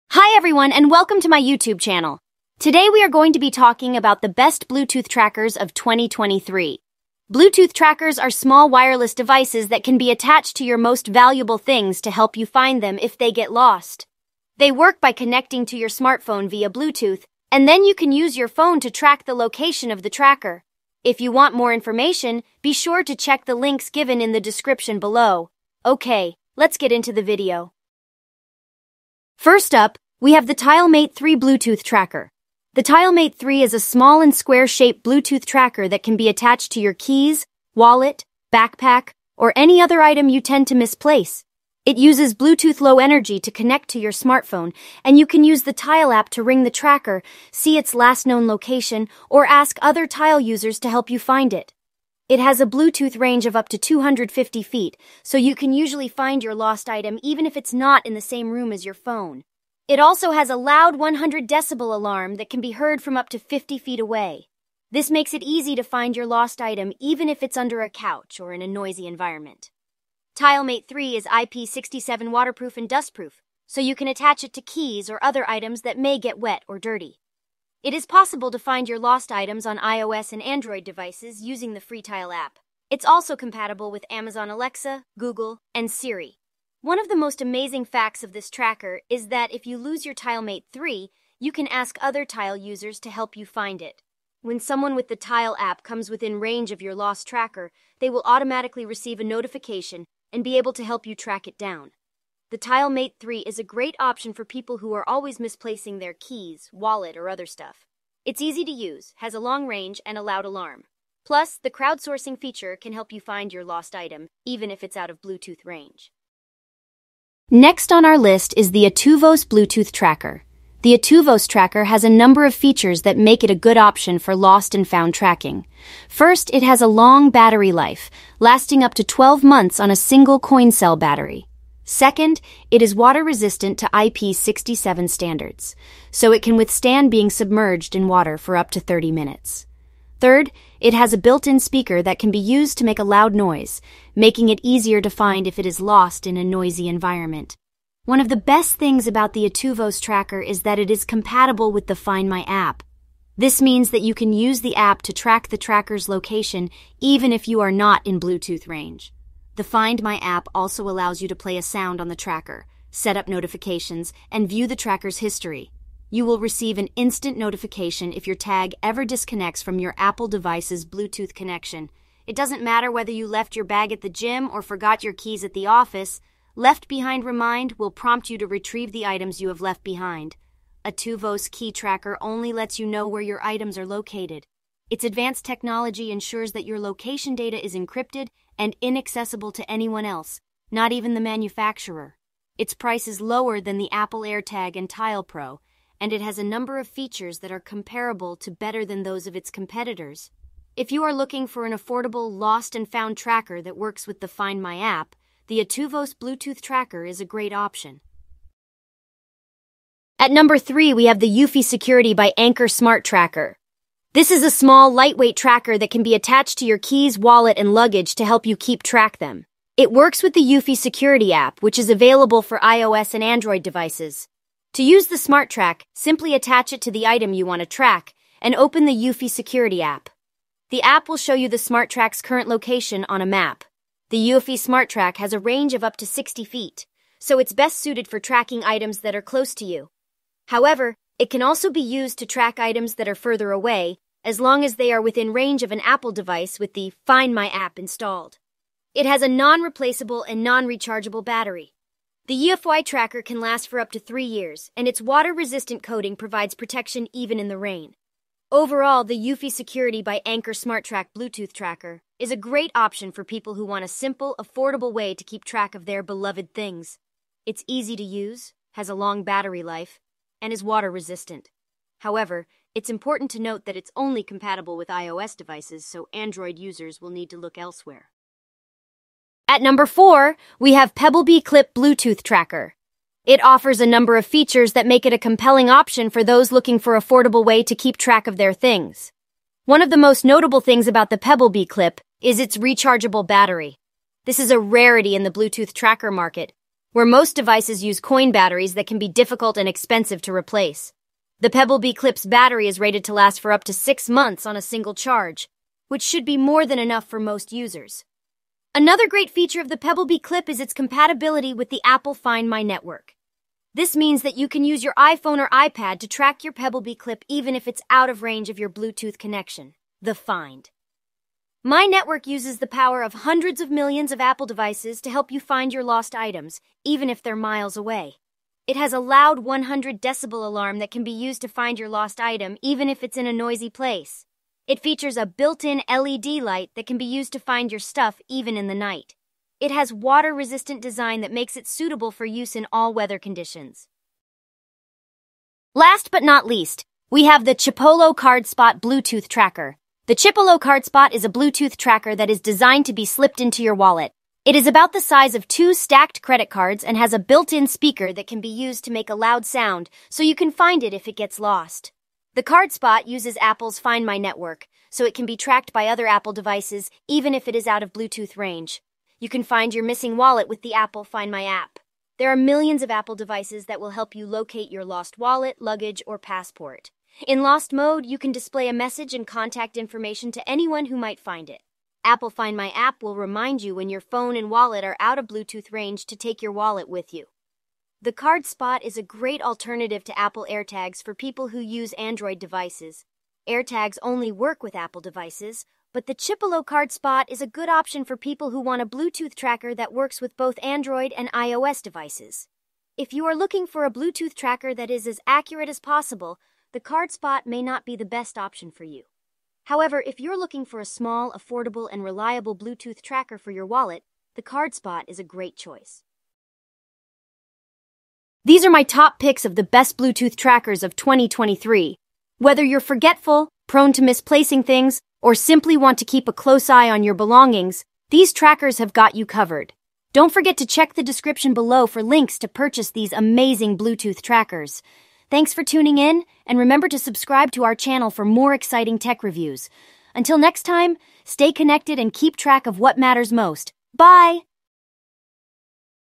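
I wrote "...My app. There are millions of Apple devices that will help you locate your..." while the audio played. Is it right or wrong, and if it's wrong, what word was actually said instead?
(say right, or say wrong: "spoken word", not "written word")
right.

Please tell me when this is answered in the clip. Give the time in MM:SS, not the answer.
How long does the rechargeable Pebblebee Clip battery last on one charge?
05:03.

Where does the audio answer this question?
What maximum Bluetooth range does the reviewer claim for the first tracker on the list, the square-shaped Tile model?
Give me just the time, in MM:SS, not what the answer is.
00:53.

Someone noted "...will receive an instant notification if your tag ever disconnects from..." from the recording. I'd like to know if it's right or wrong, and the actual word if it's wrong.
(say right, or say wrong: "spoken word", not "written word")
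right.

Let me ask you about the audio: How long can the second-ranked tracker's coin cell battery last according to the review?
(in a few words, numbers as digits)
12 months.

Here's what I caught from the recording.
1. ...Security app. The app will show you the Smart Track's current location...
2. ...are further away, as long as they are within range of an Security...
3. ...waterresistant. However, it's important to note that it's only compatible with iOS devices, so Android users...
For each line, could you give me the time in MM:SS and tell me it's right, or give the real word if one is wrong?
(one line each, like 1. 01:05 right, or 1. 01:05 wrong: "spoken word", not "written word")
1. 03:49 right
2. 04:03 wrong: "Apple", not "Security"
3. 04:30 wrong: "resistant", not "waterresistant".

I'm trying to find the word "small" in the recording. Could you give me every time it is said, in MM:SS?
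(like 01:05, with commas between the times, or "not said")
00:08, 00:33, 03:34, 06:50.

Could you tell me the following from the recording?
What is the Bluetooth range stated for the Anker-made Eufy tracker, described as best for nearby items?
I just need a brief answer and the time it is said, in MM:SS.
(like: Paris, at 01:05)
60 feet, at 03:56.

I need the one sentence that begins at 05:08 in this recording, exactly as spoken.
Another great feature of the Pebblebee Clip is its compatibility with the Apple Find My network.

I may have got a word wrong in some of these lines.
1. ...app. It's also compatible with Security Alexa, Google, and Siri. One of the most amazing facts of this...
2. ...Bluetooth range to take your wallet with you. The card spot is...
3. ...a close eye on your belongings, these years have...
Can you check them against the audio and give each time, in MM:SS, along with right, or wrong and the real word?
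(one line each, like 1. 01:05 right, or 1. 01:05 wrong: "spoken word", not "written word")
1. 01:22 wrong: "Amazon", not "Security"
2. 06:25 right
3. 07:06 wrong: "trackers", not "years".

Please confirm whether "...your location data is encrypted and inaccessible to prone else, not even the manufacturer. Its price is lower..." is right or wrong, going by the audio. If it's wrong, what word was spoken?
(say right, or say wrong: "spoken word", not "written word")
wrong: "anyone", not "prone".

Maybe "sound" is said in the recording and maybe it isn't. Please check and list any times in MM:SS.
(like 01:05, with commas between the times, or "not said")
02:41, 05:59.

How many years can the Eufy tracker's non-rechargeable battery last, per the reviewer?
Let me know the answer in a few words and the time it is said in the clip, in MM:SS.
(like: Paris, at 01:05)
3, at 04:13.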